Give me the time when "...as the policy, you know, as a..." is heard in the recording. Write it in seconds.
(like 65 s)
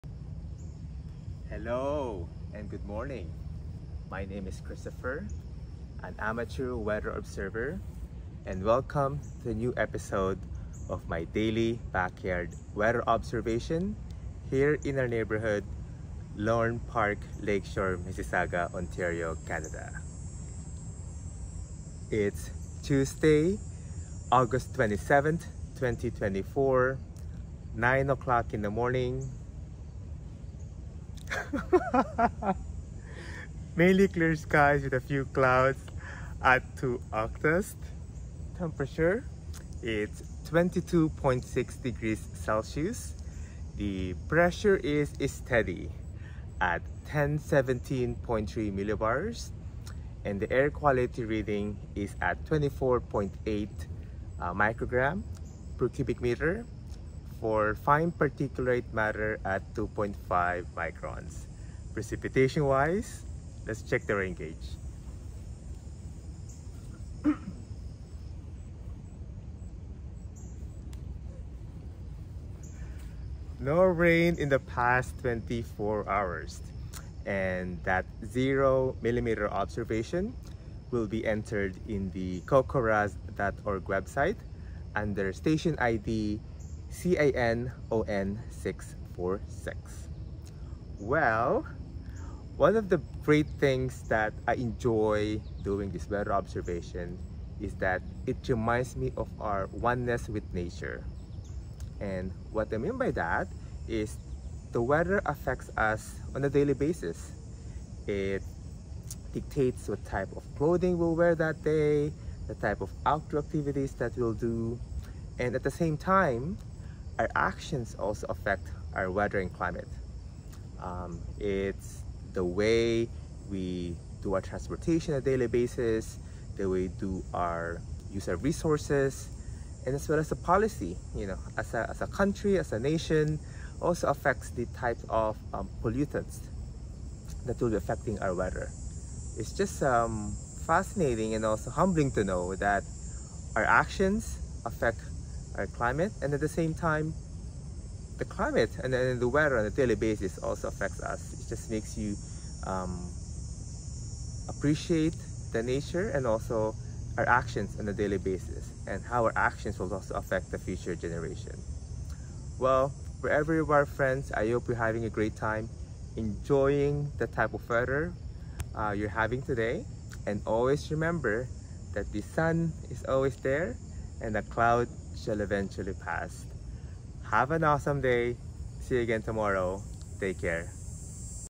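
130 s.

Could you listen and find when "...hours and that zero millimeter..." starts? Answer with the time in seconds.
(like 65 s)
76 s.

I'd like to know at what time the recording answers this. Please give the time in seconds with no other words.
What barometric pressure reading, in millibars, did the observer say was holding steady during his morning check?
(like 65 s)
47 s.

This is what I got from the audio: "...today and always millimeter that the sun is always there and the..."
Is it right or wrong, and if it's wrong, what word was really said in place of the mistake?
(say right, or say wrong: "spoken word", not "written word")
wrong: "remember", not "millimeter".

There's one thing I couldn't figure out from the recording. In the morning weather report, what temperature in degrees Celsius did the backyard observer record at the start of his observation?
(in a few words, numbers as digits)
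22.6.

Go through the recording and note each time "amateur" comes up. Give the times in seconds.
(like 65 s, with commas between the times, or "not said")
6 s.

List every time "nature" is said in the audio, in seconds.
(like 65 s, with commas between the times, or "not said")
100 s, 155 s.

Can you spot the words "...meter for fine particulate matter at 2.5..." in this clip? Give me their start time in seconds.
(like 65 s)
56 s.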